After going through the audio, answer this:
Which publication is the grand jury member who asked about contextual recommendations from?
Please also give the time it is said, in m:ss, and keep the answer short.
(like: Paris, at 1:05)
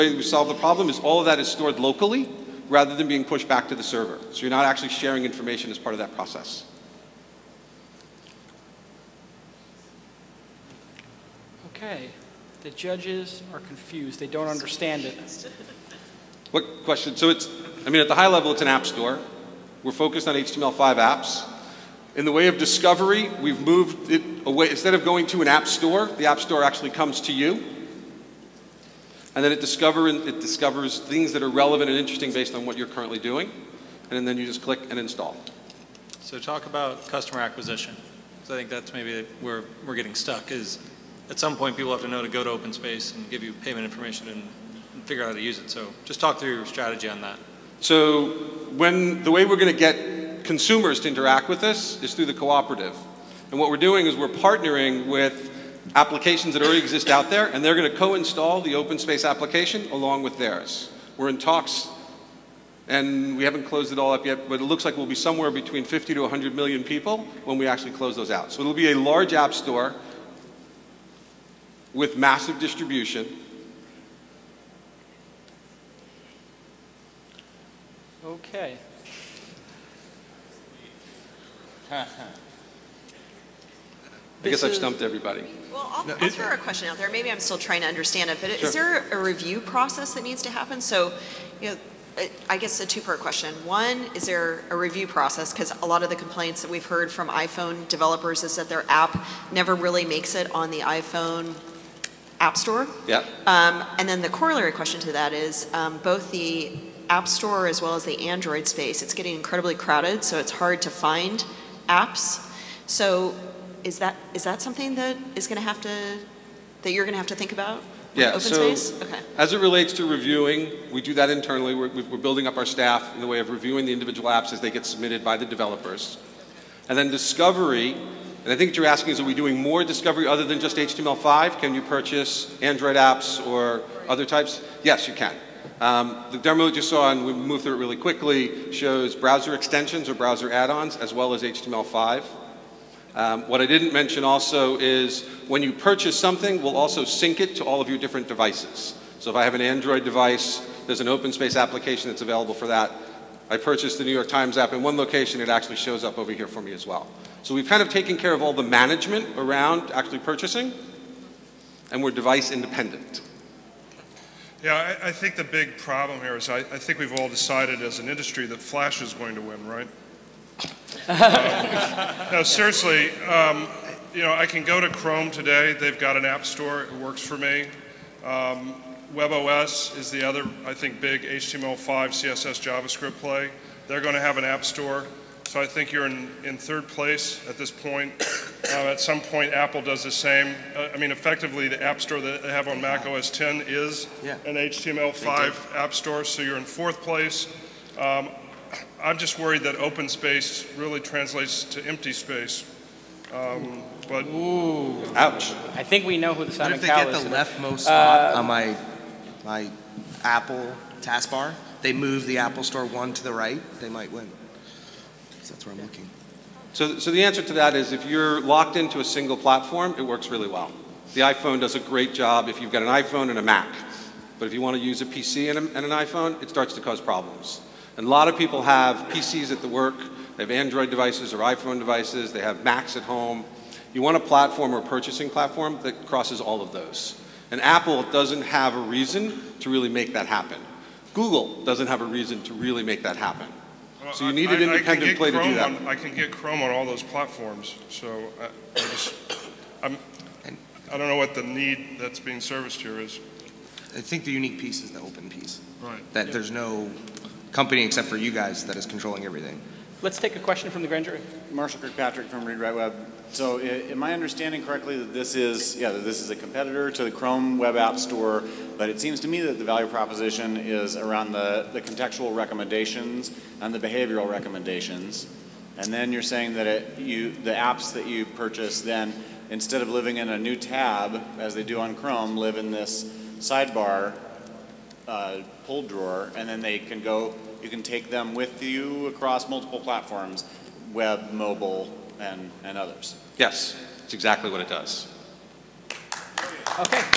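Read Write Web, at 4:22.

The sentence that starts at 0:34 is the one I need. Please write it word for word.
And then you just click and install.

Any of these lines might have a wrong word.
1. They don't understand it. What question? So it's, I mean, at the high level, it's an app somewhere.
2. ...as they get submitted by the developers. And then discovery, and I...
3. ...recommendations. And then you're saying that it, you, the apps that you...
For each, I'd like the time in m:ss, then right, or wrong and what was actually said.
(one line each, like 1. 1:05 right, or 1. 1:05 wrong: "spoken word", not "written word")
1. 0:14 wrong: "store", not "somewhere"
2. 2:04 right
3. 4:34 right.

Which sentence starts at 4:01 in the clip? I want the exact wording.
Google doesn't have a reason to really make that happen.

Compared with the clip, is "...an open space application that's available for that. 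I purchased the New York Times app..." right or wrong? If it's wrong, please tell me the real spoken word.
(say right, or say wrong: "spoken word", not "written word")
right.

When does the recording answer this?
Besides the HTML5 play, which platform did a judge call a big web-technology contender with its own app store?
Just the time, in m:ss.
2:59.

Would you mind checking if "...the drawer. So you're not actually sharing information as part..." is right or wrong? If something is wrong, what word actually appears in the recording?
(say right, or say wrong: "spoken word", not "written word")
wrong: "server", not "drawer".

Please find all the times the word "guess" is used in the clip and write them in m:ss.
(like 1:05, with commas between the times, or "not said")
1:24, 1:32.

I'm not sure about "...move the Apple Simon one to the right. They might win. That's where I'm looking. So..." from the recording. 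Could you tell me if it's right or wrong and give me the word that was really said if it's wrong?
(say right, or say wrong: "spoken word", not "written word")
wrong: "Store", not "Simon".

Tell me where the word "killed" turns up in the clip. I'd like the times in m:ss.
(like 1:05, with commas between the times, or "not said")
not said.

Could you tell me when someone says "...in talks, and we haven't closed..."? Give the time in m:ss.
1:01.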